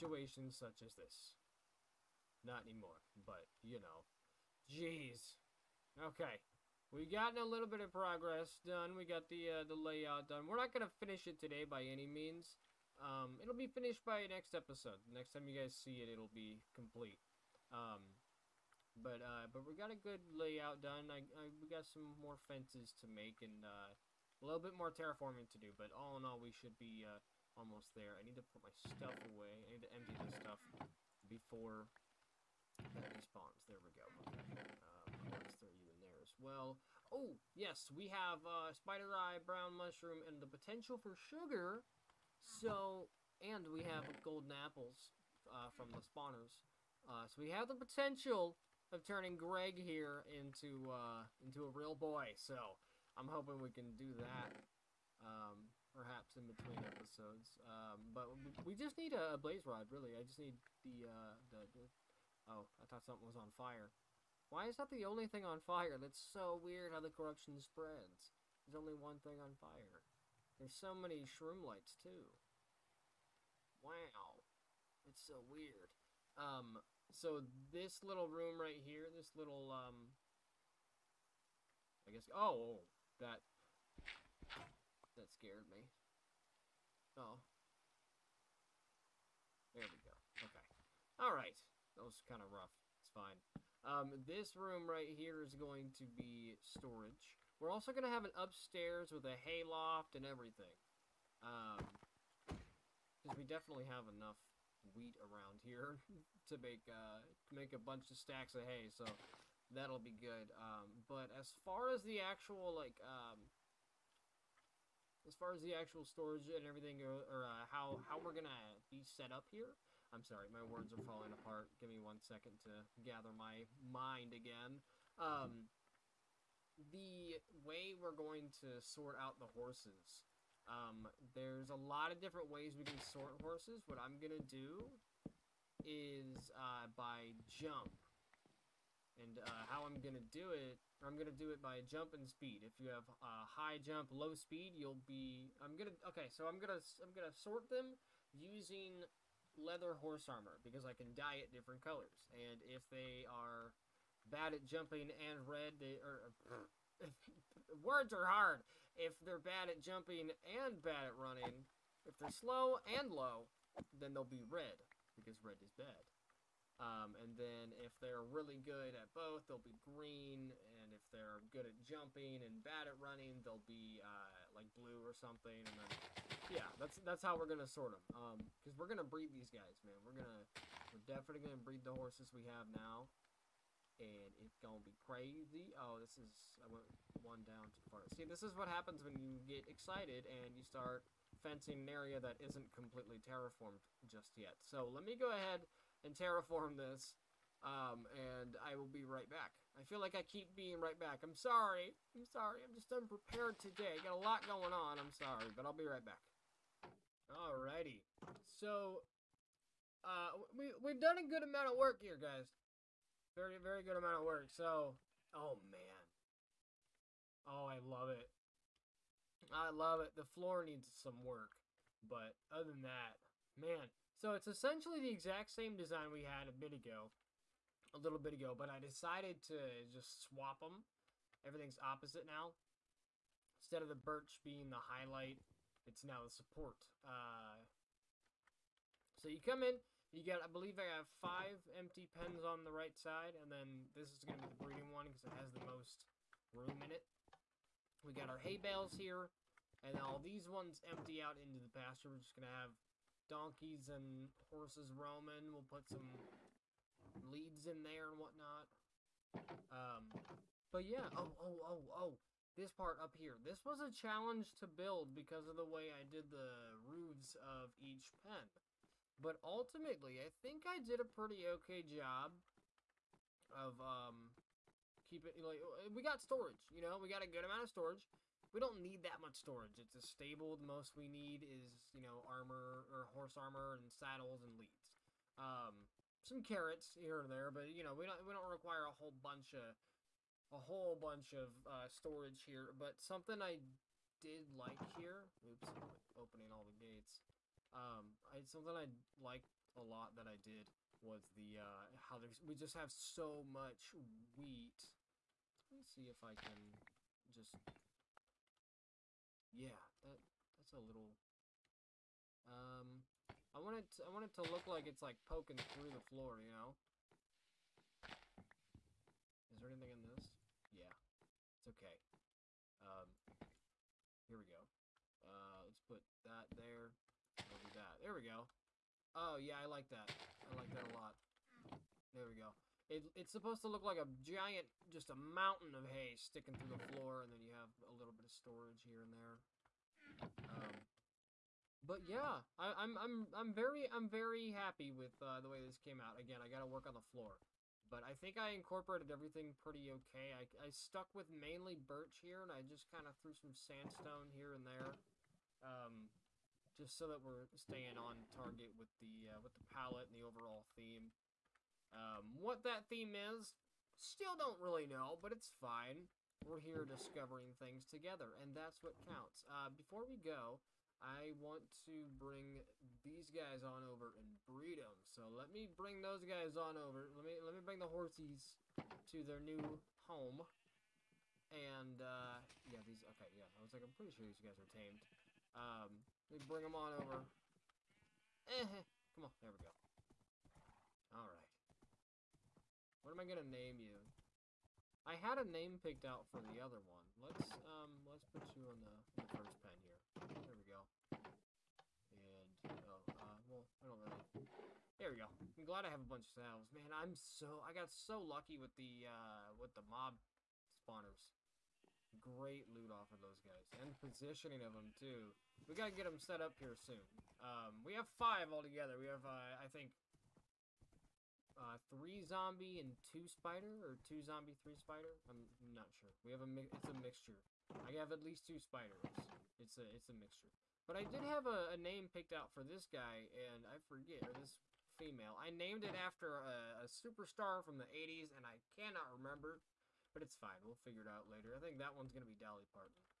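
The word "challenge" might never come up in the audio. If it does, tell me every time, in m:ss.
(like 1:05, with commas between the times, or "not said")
4:23.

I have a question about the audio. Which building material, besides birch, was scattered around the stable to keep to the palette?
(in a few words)
Sandstone.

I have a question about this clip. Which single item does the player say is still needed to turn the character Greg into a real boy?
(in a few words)
Blaze rod.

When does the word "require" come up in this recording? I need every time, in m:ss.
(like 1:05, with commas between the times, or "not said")
4:48.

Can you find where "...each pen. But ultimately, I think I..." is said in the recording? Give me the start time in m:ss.
4:27.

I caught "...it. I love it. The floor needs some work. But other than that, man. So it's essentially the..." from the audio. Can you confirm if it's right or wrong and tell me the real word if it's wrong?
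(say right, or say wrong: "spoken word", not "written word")
right.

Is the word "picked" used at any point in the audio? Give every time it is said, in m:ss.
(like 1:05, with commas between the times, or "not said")
6:35, 7:12.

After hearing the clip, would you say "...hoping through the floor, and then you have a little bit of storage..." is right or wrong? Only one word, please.
wrong.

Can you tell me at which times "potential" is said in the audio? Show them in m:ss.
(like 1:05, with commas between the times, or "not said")
0:40, 0:47.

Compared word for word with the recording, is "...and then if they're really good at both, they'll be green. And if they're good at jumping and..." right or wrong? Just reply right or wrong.
right.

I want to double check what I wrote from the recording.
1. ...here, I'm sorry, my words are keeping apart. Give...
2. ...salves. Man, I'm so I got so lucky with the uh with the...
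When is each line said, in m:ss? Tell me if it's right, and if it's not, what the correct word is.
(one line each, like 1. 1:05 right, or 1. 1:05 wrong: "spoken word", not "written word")
1. 1:59 wrong: "falling", not "keeping"
2. 6:46 right.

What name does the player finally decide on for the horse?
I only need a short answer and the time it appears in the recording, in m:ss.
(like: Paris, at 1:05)
Dolly Parton, at 7:22.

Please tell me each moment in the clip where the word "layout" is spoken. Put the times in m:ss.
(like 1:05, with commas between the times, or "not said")
0:09, 0:20.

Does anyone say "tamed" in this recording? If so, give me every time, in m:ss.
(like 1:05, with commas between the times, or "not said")
6:24.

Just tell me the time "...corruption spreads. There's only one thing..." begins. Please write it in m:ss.
1:07.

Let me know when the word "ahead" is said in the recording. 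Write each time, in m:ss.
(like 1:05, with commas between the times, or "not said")
3:15.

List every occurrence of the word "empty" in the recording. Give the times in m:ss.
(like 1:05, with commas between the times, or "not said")
0:29, 4:01, 4:10.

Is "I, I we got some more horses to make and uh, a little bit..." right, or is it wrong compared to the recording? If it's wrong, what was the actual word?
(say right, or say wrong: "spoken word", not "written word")
wrong: "fences", not "horses".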